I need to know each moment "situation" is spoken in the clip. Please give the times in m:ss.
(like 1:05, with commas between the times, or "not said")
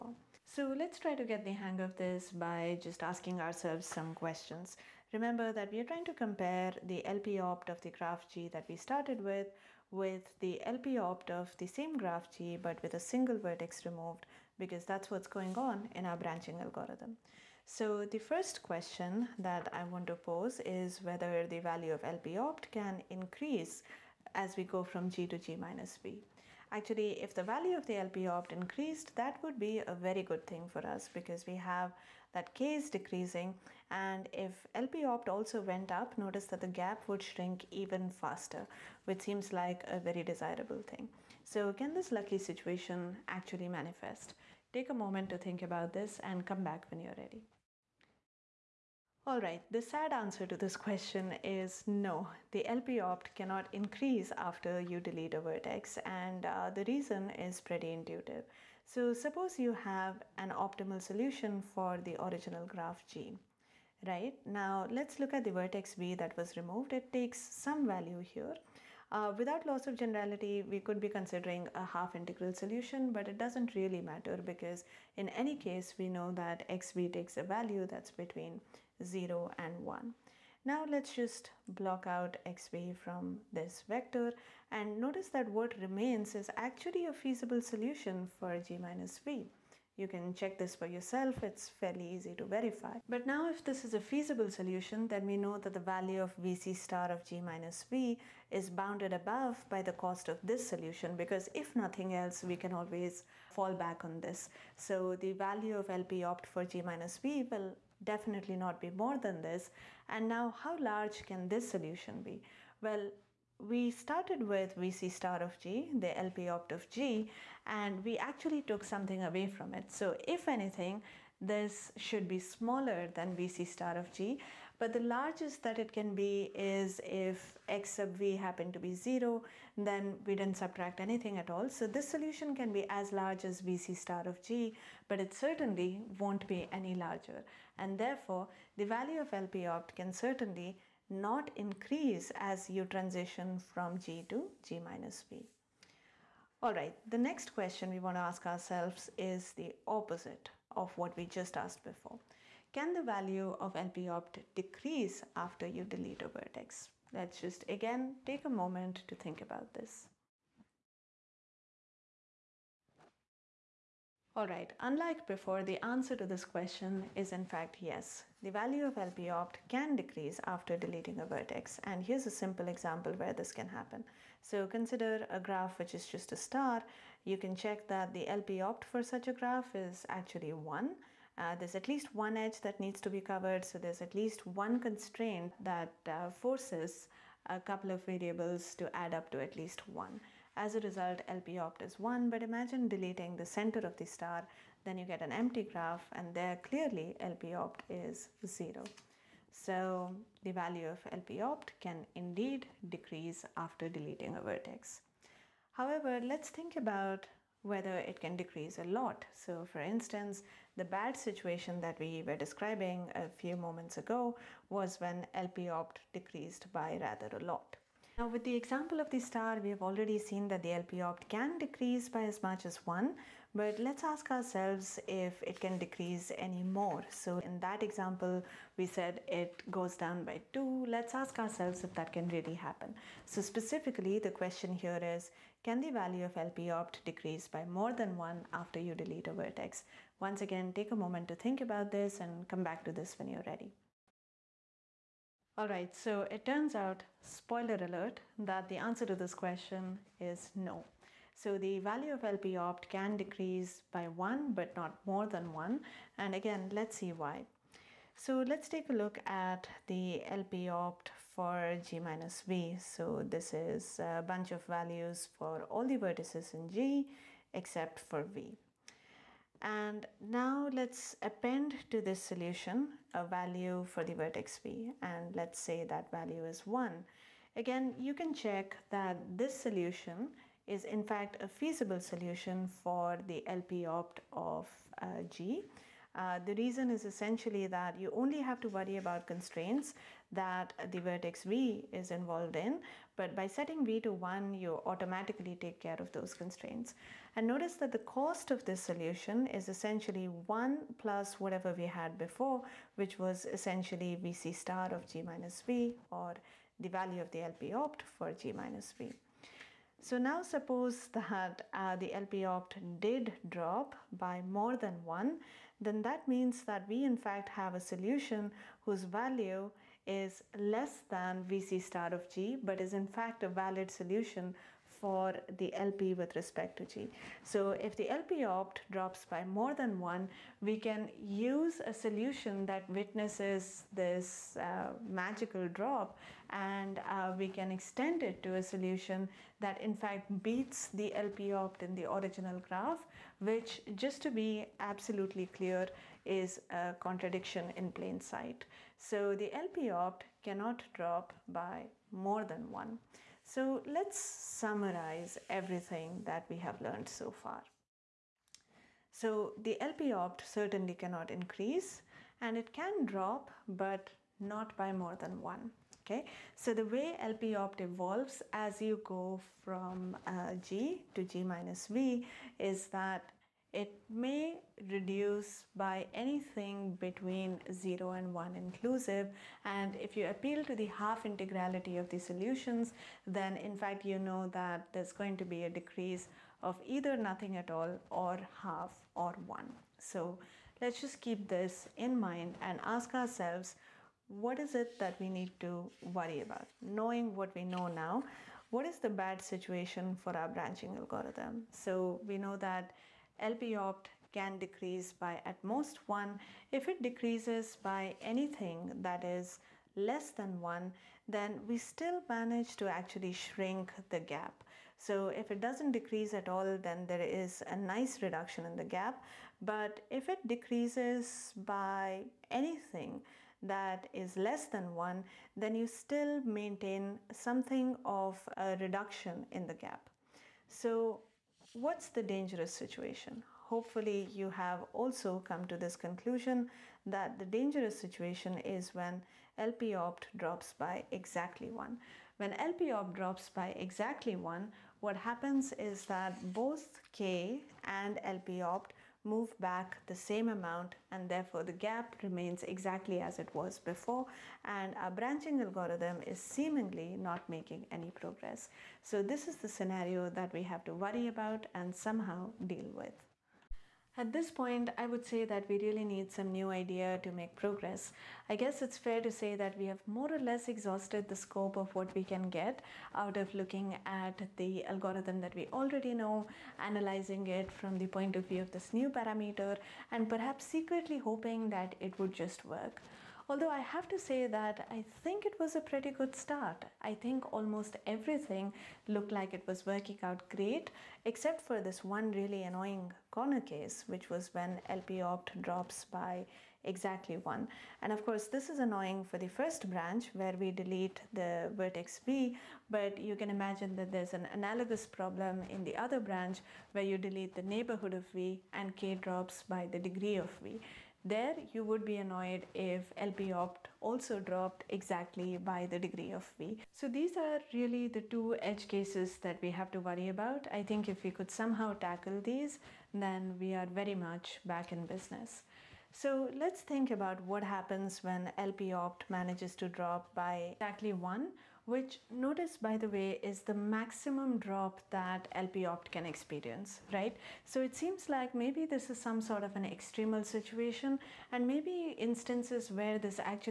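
0:42, 3:31, 6:39, 7:12, 7:17, 9:00.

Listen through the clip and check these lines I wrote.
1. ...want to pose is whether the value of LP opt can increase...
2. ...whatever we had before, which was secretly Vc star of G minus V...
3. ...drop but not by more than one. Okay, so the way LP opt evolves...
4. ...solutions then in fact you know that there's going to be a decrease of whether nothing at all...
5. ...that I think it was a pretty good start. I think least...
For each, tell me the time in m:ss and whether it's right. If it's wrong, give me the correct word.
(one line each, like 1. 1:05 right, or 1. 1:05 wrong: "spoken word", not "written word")
1. 0:19 right
2. 5:01 wrong: "essentially", not "secretly"
3. 6:03 right
4. 6:22 wrong: "either", not "whether"
5. 8:04 wrong: "almost", not "least".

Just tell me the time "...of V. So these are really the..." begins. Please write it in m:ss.
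8:36.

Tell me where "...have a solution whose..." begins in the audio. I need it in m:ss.
5:17.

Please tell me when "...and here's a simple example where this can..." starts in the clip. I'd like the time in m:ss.
2:51.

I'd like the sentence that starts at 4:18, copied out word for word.
So let's take a look at the LP opt for G minus V.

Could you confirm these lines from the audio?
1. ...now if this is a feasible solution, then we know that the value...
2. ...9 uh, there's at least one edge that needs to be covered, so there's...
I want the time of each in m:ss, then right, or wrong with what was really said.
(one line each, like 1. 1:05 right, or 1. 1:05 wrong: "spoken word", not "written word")
1. 1:33 right
2. 3:00 wrong: "1", not "9".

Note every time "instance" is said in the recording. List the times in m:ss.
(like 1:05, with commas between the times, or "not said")
3:29, 9:02.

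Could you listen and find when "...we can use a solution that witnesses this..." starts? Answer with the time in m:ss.
5:30.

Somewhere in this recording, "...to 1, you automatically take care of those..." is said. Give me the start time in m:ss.
4:54.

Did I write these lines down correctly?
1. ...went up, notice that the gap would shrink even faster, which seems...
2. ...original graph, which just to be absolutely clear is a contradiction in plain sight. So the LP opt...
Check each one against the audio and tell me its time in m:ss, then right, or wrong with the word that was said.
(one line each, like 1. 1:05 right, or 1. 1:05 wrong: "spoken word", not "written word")
1. 0:35 right
2. 5:42 right.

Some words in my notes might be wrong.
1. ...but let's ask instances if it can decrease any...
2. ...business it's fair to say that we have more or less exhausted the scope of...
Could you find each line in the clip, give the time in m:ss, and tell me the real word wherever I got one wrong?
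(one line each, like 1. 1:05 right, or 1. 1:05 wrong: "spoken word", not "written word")
1. 3:43 wrong: "ourselves", not "instances"
2. 7:48 wrong: "guess", not "business".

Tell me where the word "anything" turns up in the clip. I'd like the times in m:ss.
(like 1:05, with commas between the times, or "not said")
2:00, 2:11, 6:16, 6:48, 7:02.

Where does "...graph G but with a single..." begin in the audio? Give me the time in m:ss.
0:11.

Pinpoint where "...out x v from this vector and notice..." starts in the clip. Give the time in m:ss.
1:22.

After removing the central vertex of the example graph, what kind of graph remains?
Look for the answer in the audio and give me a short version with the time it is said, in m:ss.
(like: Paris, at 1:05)
An empty graph, at 3:15.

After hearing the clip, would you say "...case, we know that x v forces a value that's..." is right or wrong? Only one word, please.
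wrong.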